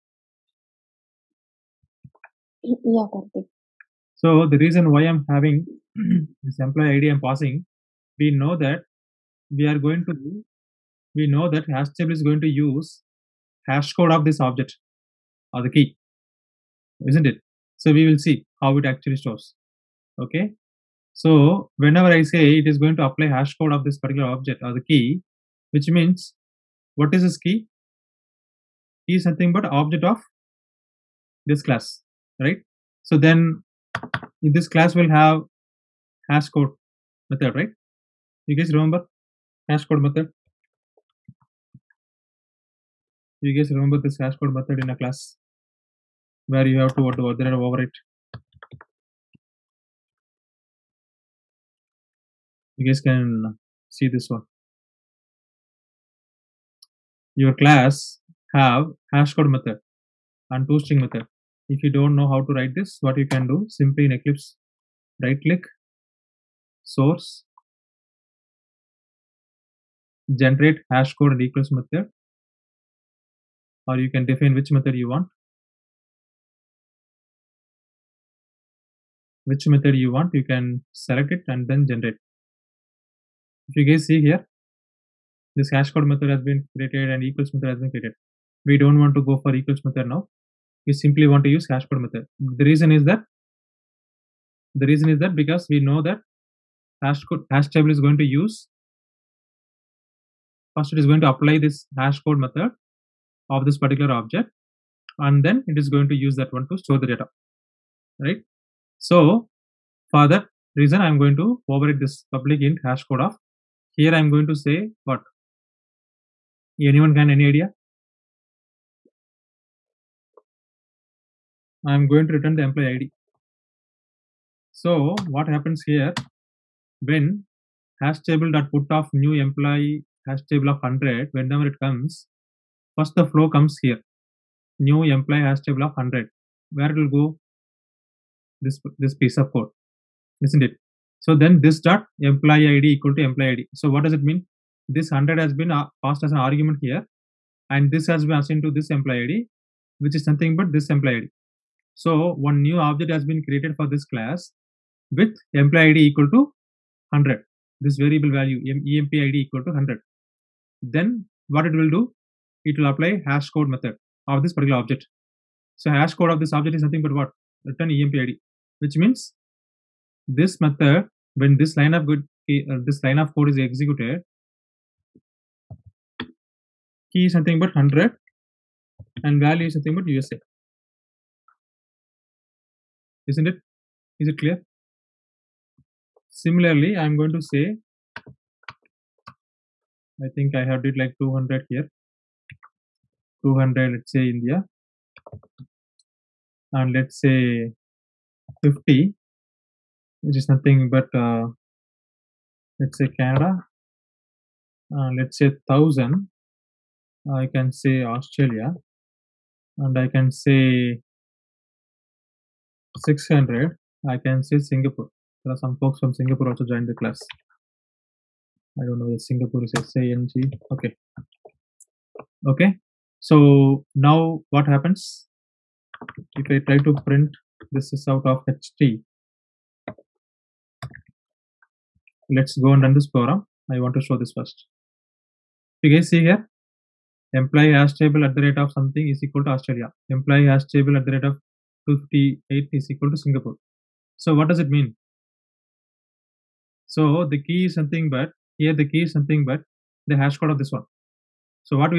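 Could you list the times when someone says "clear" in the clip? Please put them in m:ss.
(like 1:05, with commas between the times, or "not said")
3:04.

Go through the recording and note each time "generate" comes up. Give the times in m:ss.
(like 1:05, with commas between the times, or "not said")
1:10, 1:21.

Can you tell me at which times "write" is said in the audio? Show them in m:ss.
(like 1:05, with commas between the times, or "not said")
1:02.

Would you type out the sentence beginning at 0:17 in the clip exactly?
So we will see how it actually stores.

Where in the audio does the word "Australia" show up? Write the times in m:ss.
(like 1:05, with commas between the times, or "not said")
3:28, 3:59.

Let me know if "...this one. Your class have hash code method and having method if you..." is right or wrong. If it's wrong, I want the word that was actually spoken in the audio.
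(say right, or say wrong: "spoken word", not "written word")
wrong: "toString", not "having".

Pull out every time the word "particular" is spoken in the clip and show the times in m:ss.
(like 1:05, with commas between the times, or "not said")
0:23, 1:43, 2:44.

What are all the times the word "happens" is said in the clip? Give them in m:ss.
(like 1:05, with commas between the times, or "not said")
2:05, 3:44.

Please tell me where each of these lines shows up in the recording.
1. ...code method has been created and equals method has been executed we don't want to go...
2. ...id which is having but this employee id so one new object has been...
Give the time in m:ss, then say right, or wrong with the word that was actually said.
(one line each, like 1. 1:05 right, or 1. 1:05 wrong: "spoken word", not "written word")
1. 1:25 wrong: "created", not "executed"
2. 2:29 wrong: "nothing", not "having".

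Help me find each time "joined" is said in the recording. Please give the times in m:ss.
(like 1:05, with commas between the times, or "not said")
3:36.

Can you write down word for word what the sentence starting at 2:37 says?
This variable value emp ID equal to 100.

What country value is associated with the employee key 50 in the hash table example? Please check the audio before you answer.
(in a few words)
Canada.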